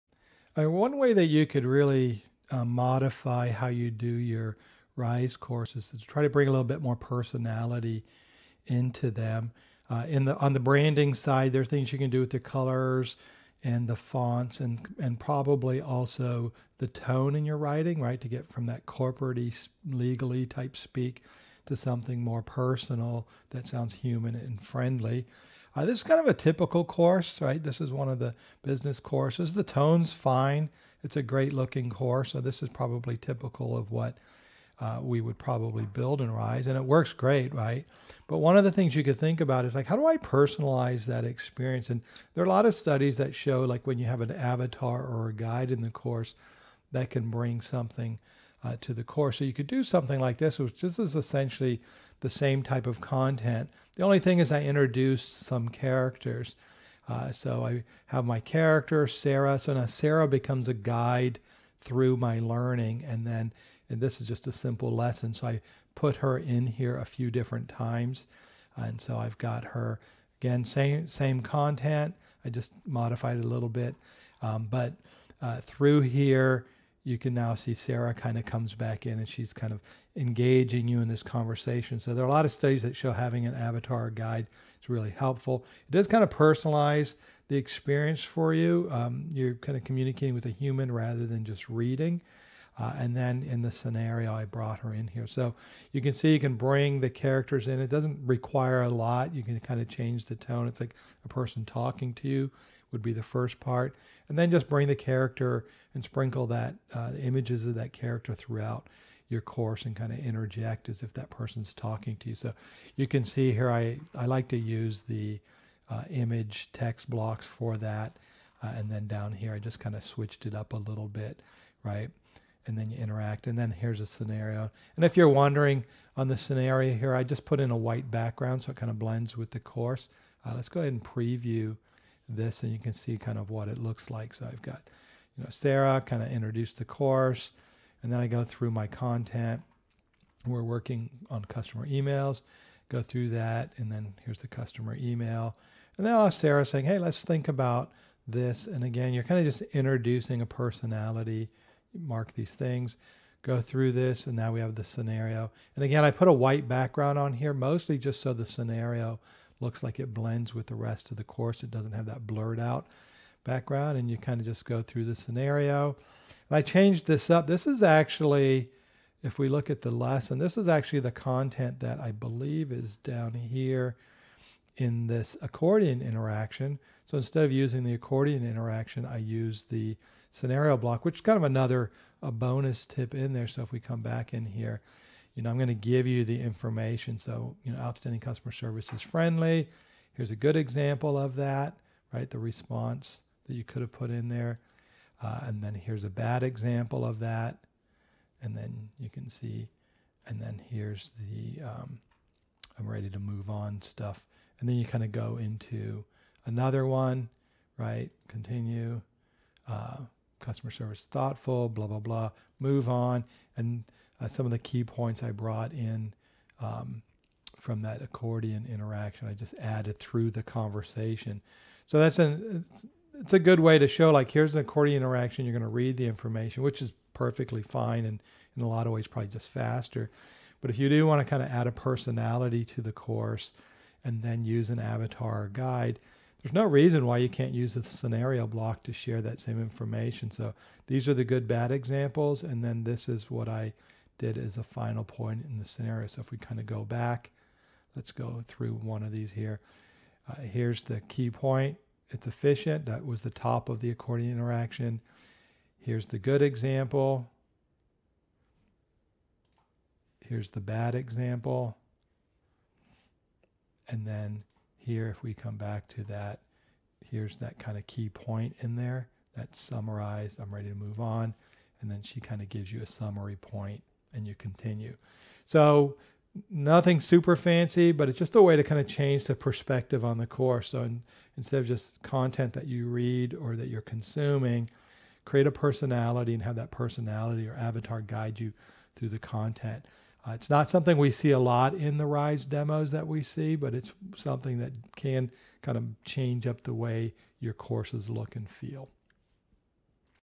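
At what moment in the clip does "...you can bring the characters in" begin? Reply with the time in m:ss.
1:36.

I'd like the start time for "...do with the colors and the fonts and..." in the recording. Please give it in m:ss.
0:12.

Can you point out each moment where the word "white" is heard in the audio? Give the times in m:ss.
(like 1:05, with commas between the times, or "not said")
2:07, 2:36.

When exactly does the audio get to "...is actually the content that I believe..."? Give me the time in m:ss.
2:50.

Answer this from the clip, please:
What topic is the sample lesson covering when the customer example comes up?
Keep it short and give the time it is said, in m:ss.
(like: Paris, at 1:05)
Customer emails, at 2:21.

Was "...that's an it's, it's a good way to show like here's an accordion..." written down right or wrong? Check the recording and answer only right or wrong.
right.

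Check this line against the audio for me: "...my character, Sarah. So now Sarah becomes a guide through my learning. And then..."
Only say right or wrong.
right.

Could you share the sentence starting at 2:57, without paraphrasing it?
So instead of using the accordion interaction, I use the scenario block, which is kind of another a bonus tip in there.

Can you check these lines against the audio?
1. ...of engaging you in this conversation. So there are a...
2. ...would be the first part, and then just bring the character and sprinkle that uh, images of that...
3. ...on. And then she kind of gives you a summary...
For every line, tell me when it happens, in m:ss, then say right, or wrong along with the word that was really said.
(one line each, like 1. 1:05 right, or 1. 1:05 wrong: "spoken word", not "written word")
1. 1:19 right
2. 1:42 right
3. 4:30 right.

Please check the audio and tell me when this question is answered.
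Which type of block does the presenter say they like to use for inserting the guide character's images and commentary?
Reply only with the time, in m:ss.
1:56.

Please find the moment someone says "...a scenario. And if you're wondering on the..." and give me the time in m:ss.
2:04.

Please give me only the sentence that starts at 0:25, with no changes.
Uh, this is kind of a typical course, right?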